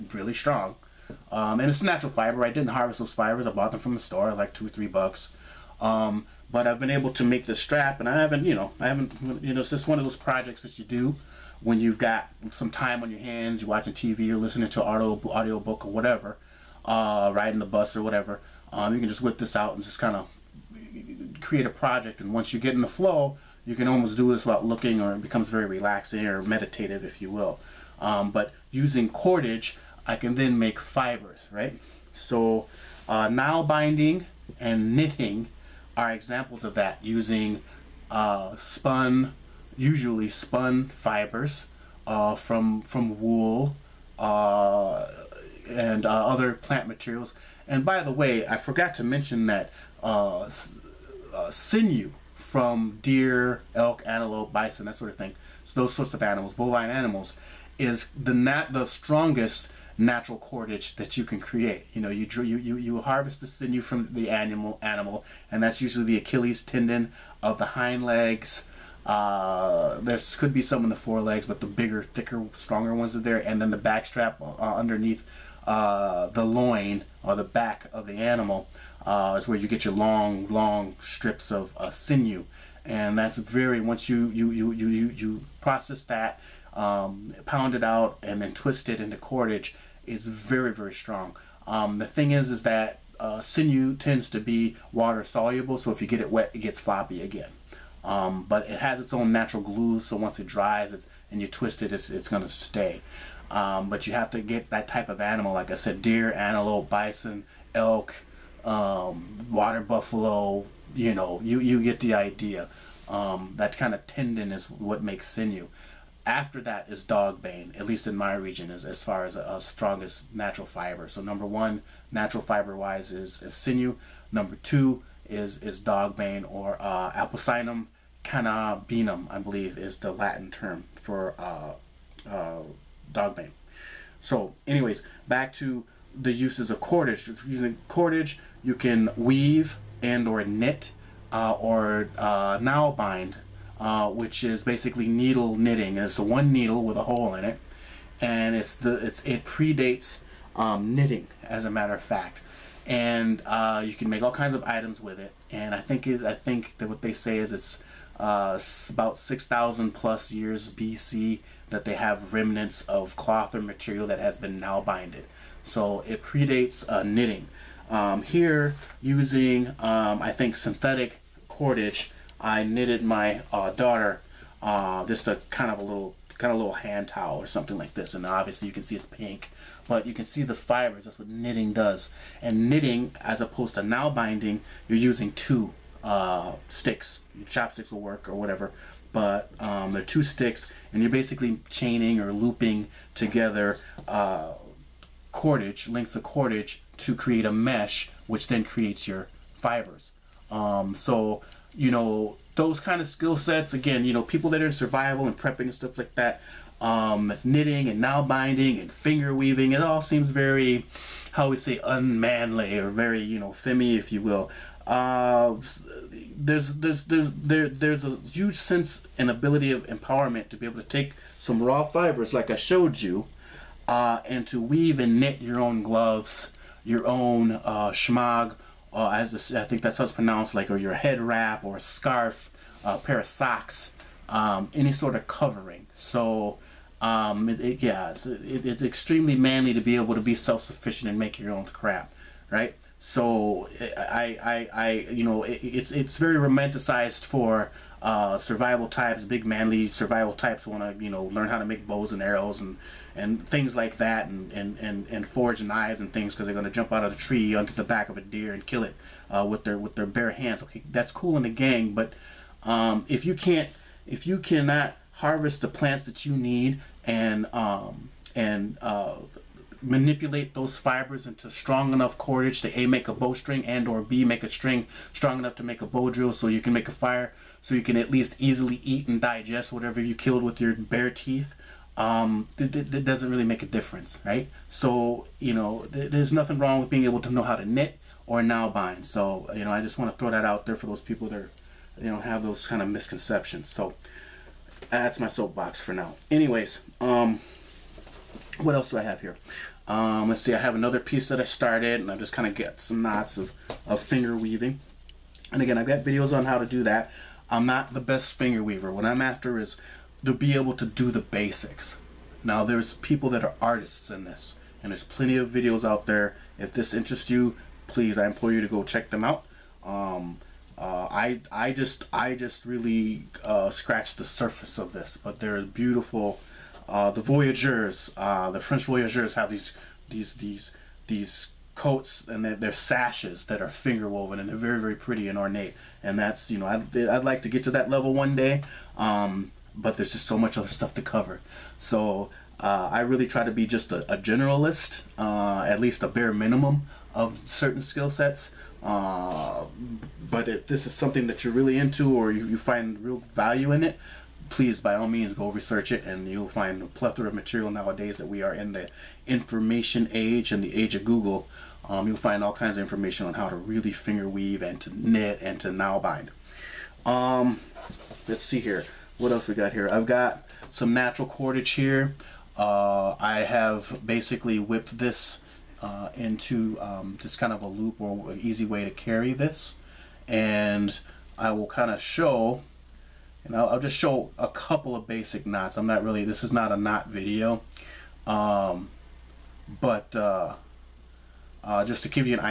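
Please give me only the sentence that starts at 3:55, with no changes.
So um, it, it, yeah, it's, it, it's extremely manly to be able to be self-sufficient and make your own crap, right?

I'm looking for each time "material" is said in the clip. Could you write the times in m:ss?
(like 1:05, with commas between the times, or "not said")
0:46, 2:43, 5:57.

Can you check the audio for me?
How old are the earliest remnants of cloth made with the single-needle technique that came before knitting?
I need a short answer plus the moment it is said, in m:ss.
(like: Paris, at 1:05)
6,000+ years BC, at 2:39.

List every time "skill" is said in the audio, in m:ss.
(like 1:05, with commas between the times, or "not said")
3:23, 5:47.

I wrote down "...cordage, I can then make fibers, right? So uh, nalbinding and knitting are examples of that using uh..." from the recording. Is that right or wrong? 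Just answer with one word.
right.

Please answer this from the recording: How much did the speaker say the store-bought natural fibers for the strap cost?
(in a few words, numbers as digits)
2 or 3 bucks.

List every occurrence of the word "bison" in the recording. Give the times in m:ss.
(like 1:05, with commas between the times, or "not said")
0:54, 1:46.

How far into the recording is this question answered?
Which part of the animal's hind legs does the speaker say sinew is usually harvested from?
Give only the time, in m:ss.
1:06.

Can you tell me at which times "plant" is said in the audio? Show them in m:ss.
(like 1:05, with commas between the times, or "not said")
0:46, 4:25.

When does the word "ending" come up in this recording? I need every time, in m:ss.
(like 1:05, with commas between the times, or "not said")
not said.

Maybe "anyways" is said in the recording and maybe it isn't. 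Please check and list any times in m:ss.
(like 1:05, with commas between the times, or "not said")
2:14, 4:56.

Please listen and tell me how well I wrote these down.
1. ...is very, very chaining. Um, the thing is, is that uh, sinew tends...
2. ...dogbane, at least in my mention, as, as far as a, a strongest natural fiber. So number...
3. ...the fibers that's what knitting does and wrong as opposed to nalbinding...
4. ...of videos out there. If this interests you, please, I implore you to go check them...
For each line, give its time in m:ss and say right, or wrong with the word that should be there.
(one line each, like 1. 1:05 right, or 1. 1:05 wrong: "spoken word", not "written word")
1. 1:30 wrong: "strong", not "chaining"
2. 1:57 wrong: "region", not "mention"
3. 3:00 wrong: "knitting", not "wrong"
4. 5:15 right.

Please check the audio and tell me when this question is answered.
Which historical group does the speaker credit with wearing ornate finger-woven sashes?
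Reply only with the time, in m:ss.
5:28.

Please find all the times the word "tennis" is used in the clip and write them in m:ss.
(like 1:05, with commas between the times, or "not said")
not said.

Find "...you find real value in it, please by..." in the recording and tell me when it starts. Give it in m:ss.
5:52.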